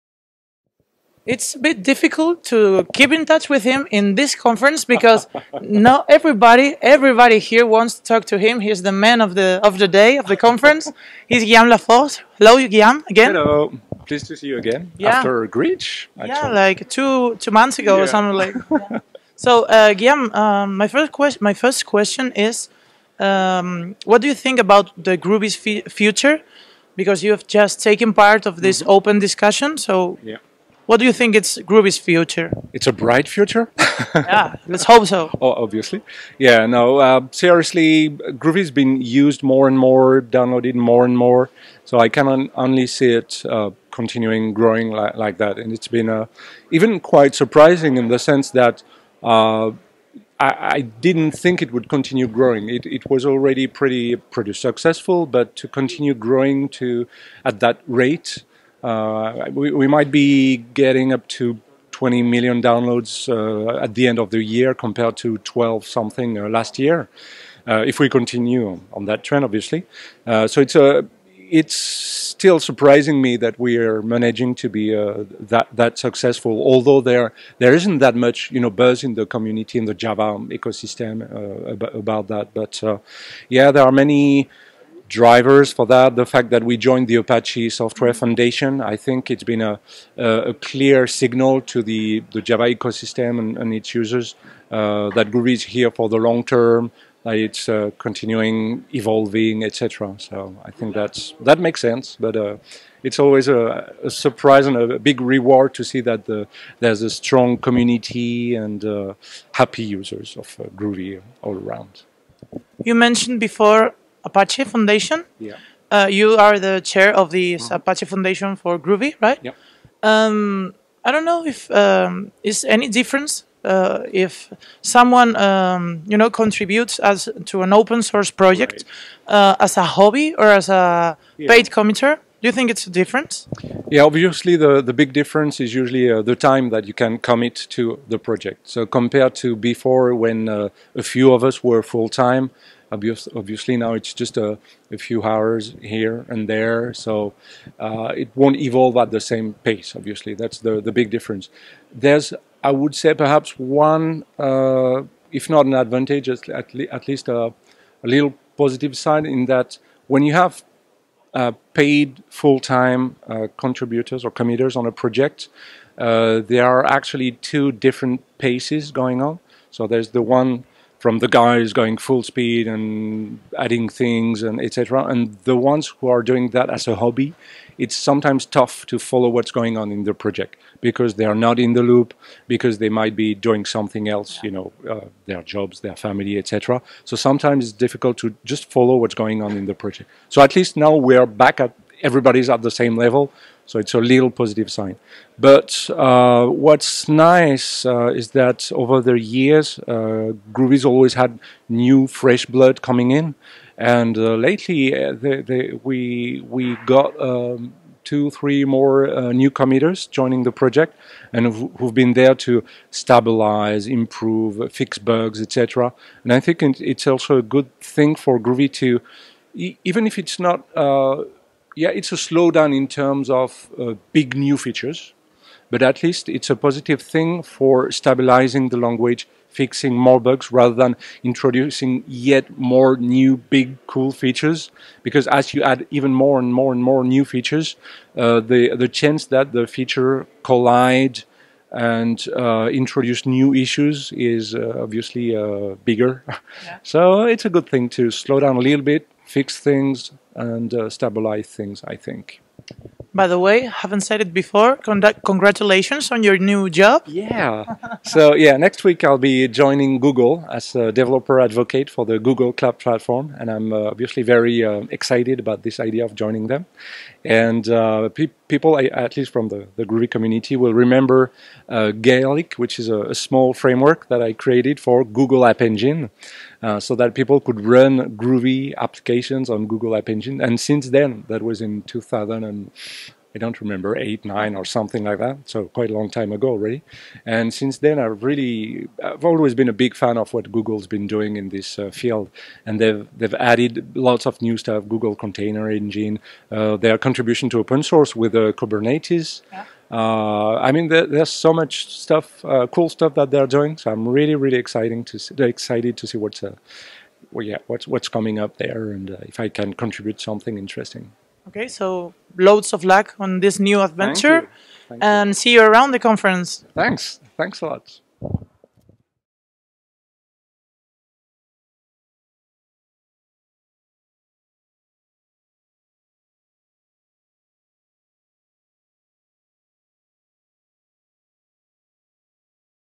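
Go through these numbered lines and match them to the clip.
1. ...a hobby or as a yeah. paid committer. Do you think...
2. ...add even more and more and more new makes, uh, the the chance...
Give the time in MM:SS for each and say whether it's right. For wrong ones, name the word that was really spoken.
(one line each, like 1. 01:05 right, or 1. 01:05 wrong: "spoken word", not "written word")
1. 02:09 right
2. 03:55 wrong: "features", not "makes".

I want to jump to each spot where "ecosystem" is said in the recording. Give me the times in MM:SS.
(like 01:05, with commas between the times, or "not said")
01:20, 01:32.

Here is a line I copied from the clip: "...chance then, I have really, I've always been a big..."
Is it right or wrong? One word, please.
wrong.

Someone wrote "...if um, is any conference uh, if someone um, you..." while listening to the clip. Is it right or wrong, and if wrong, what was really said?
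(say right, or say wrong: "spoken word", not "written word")
wrong: "difference", not "conference".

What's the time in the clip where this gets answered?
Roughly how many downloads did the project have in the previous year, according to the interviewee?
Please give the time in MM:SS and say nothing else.
01:05.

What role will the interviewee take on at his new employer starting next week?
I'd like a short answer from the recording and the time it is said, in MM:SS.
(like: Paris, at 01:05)
developer advocate, at 04:20.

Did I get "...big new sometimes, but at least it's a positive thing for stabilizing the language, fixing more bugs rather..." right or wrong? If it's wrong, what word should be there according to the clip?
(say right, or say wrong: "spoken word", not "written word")
wrong: "features", not "sometimes".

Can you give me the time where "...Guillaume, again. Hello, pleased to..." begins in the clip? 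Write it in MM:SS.
00:12.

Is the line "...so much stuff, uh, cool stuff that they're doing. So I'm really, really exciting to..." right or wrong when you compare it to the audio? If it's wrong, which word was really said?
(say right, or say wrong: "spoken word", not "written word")
right.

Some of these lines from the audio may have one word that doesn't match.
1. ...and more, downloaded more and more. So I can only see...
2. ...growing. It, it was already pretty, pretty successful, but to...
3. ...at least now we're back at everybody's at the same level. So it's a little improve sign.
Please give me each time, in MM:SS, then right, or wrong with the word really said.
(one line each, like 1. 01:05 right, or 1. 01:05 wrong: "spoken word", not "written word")
1. 00:39 right
2. 00:52 right
3. 03:10 wrong: "positive", not "improve".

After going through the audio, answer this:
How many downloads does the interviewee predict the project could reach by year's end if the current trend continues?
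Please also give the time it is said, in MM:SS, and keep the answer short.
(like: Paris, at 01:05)
20 million, at 01:01.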